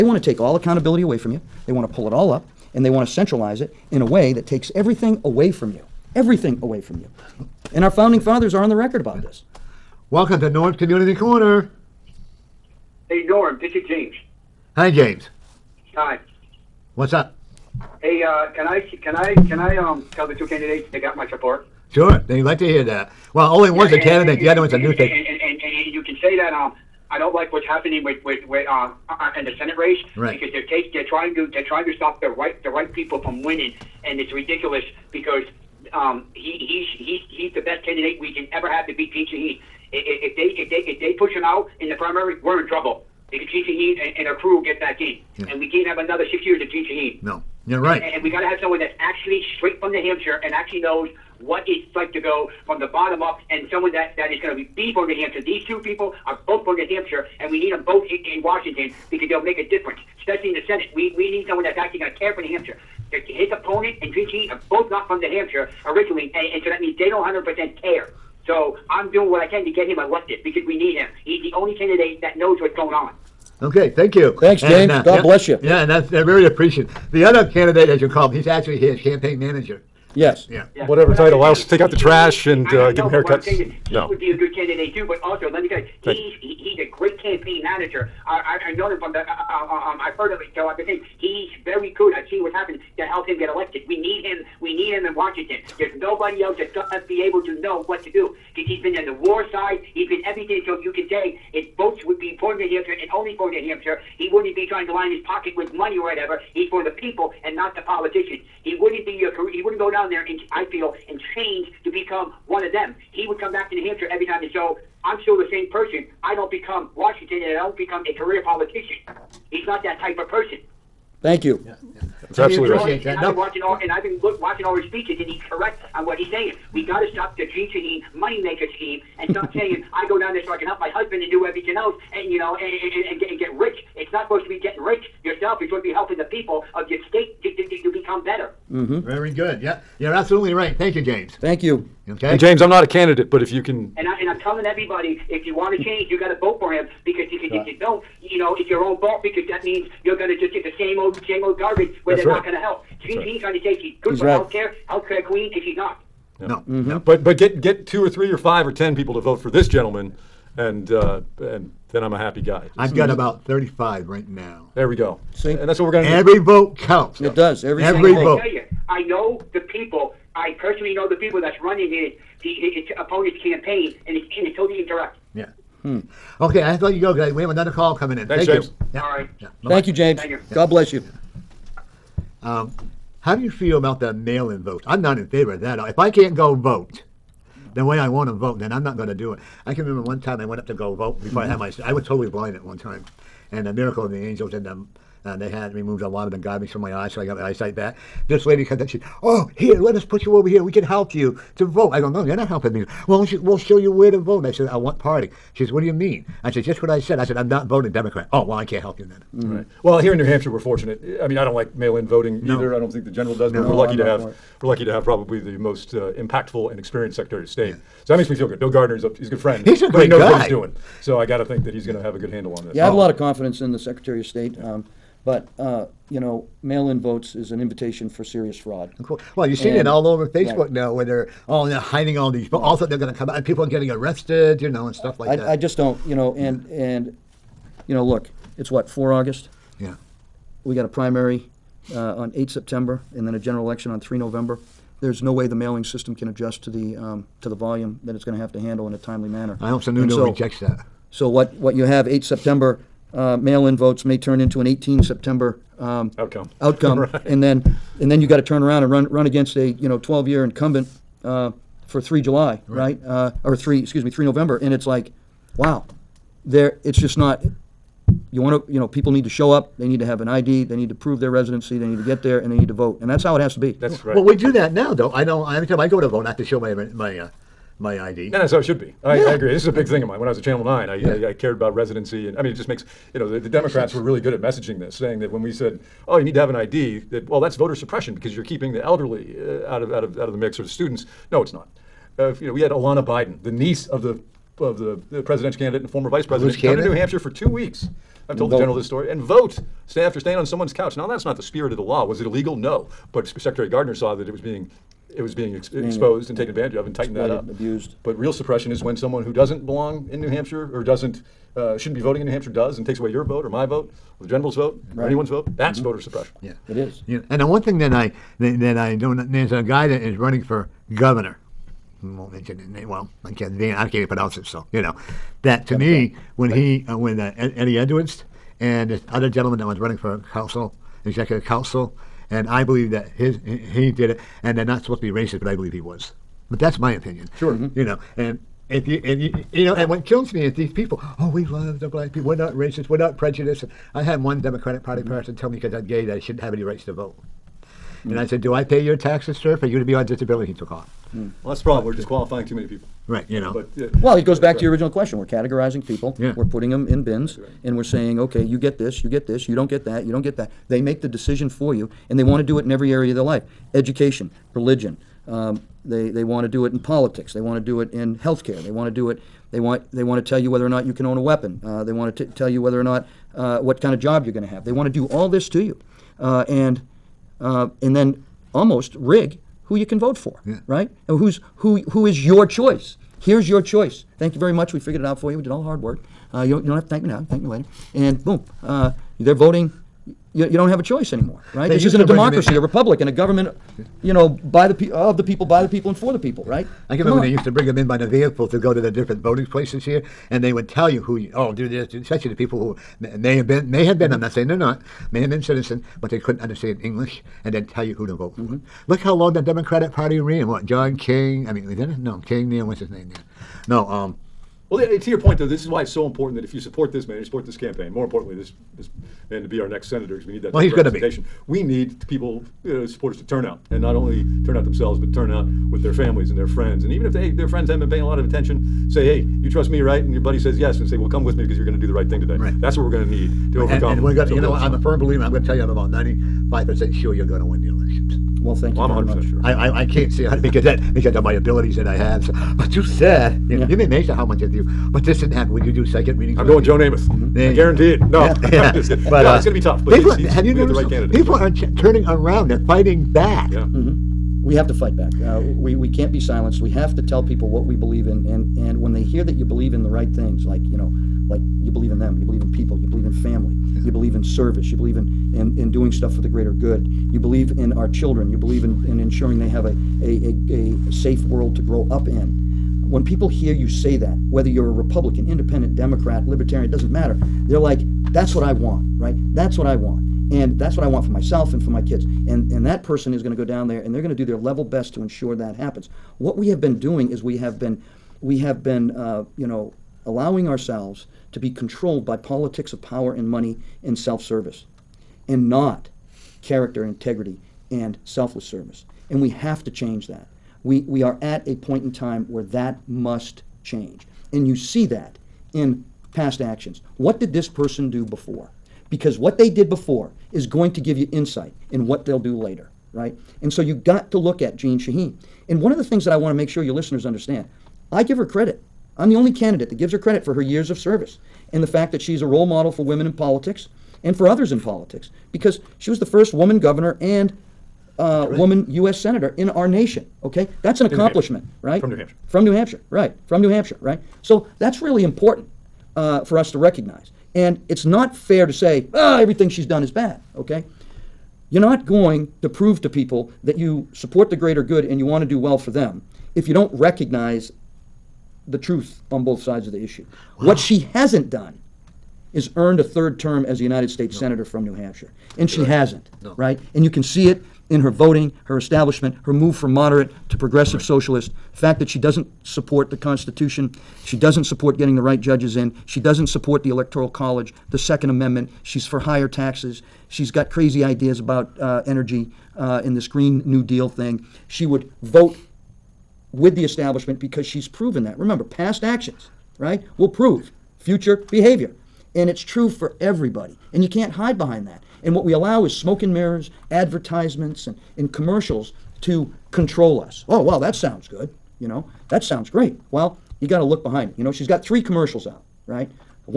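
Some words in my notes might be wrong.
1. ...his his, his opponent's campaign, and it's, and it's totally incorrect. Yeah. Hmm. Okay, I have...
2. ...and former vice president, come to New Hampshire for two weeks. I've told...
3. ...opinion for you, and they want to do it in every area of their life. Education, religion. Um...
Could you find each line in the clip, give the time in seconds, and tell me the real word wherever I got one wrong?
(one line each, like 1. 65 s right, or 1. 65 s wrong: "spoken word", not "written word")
1. 171 s right
2. 295 s right
3. 361 s wrong: "decision", not "opinion".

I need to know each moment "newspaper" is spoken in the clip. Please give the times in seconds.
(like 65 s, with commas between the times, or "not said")
24 s.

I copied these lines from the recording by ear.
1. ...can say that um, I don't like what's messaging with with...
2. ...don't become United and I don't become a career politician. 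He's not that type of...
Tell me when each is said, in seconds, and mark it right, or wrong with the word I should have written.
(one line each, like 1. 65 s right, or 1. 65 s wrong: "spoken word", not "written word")
1. 26 s wrong: "happening", not "messaging"
2. 116 s wrong: "Washington", not "United".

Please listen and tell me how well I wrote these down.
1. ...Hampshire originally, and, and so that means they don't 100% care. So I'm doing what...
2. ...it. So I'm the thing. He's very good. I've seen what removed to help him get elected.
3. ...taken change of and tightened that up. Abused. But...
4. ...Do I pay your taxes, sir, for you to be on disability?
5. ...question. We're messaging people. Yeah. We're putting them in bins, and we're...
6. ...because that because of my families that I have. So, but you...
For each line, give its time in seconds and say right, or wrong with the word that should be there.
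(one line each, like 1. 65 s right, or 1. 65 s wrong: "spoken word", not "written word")
1. 65 s right
2. 90 s wrong: "happened", not "removed"
3. 306 s wrong: "advantage", not "change"
4. 348 s right
5. 354 s wrong: "categorizing", not "messaging"
6. 440 s wrong: "abilities", not "families".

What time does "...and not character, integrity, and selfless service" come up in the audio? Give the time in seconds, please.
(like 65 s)
495 s.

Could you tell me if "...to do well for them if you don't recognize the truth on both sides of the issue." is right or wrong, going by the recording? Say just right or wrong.
right.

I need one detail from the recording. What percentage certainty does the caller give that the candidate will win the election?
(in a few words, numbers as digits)
95 percent.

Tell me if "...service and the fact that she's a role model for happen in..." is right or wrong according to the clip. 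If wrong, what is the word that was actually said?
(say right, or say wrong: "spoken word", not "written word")
wrong: "women", not "happen".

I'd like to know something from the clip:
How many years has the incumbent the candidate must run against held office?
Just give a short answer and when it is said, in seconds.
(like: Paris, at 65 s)
12 years, at 259 s.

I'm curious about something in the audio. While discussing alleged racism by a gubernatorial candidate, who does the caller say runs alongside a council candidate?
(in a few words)
Eddie Edwards.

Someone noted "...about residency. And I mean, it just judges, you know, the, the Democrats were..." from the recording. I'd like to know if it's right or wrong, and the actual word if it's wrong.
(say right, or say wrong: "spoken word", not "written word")
wrong: "makes", not "judges".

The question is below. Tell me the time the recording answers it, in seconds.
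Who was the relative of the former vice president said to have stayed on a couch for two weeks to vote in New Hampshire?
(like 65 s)
292 s.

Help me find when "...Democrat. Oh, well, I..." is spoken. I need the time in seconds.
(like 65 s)
207 s.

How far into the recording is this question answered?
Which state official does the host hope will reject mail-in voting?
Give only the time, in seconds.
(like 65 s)
249 s.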